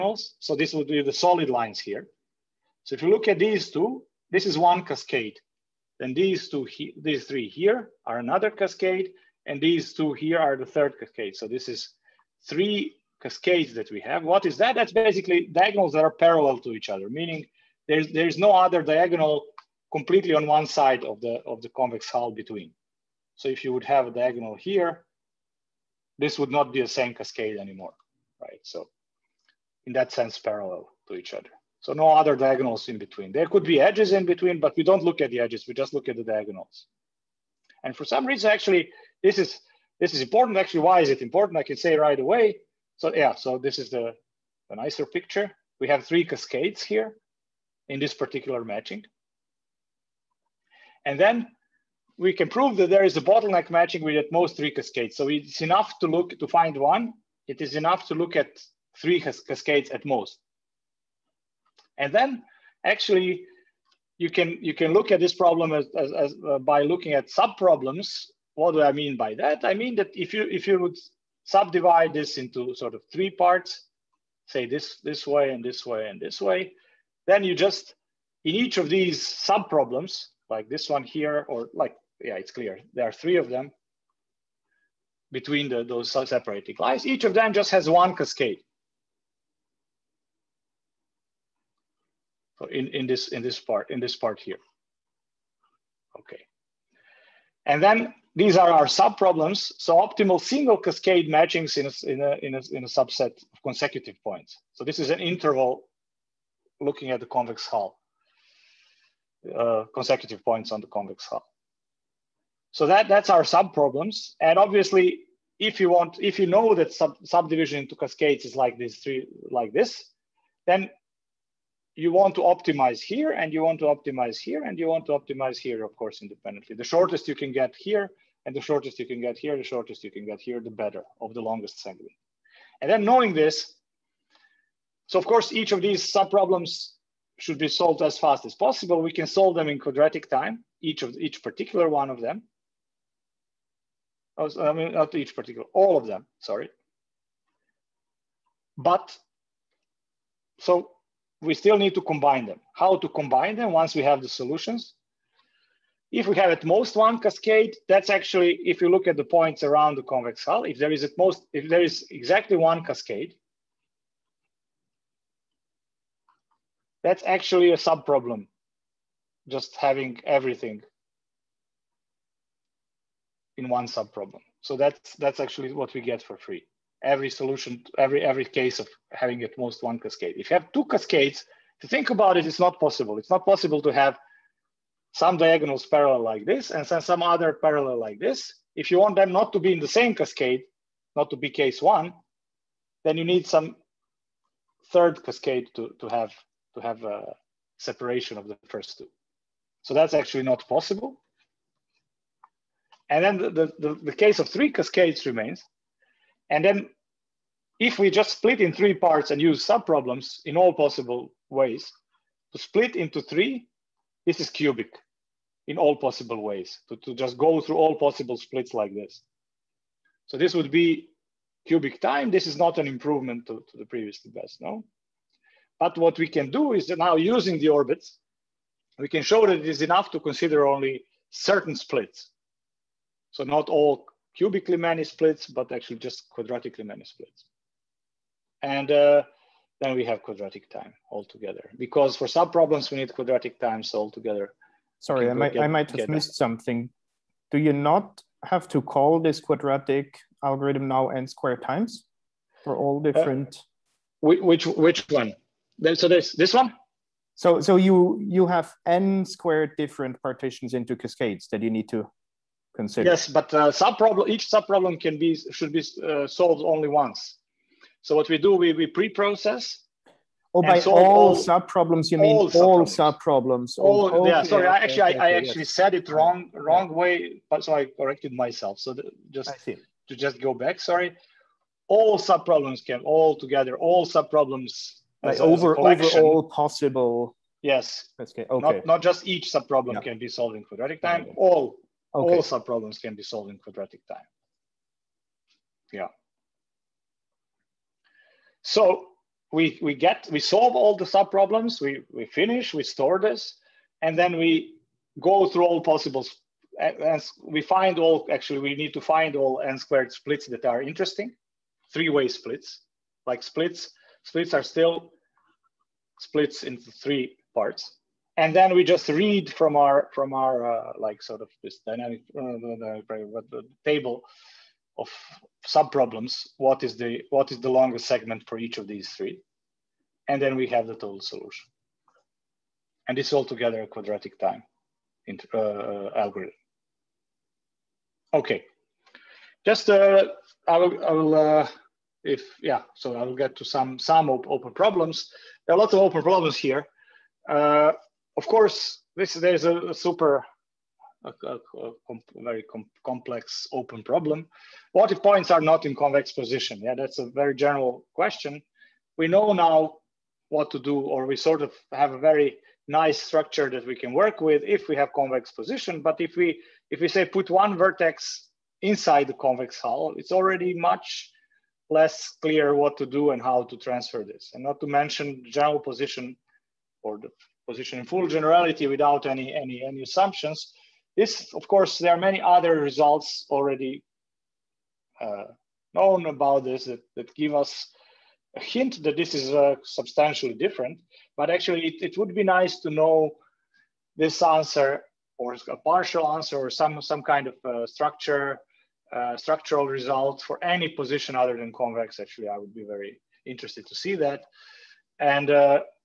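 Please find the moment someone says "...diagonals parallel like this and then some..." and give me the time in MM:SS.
03:05.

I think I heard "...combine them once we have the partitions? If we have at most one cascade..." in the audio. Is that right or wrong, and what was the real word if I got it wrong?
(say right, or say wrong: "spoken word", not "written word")
wrong: "solutions", not "partitions".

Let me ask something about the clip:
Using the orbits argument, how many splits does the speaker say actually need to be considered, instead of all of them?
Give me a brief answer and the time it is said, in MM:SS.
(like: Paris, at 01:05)
Quadratically many, at 03:55.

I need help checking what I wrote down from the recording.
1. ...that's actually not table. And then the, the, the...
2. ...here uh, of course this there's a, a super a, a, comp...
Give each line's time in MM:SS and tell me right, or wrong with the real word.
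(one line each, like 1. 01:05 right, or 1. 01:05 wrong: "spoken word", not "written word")
1. 03:19 wrong: "possible", not "table"
2. 05:46 right.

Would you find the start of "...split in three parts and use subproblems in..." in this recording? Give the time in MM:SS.
03:28.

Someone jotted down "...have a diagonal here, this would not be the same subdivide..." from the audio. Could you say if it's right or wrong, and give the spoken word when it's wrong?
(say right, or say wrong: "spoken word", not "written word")
wrong: "cascade", not "subdivide".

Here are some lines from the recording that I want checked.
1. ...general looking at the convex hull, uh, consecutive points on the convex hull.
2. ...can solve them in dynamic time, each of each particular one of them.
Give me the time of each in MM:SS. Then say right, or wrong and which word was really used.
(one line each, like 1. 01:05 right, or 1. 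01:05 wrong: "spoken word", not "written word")
1. 01:45 wrong: "interval", not "general"
2. 02:19 wrong: "quadratic", not "dynamic".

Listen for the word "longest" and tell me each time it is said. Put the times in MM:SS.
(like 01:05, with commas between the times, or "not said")
02:11, 05:27.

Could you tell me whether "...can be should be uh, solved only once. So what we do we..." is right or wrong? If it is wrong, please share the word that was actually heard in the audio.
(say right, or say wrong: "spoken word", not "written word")
right.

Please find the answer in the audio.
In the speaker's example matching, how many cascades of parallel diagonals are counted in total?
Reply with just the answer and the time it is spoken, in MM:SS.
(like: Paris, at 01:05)
3, at 00:11.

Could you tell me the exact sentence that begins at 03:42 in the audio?
This is not an improvement to, to the previously best, no?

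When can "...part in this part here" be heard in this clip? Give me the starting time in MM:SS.
01:33.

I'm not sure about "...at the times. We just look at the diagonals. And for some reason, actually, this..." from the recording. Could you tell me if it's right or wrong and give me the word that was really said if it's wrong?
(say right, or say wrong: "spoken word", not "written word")
wrong: "edges", not "times".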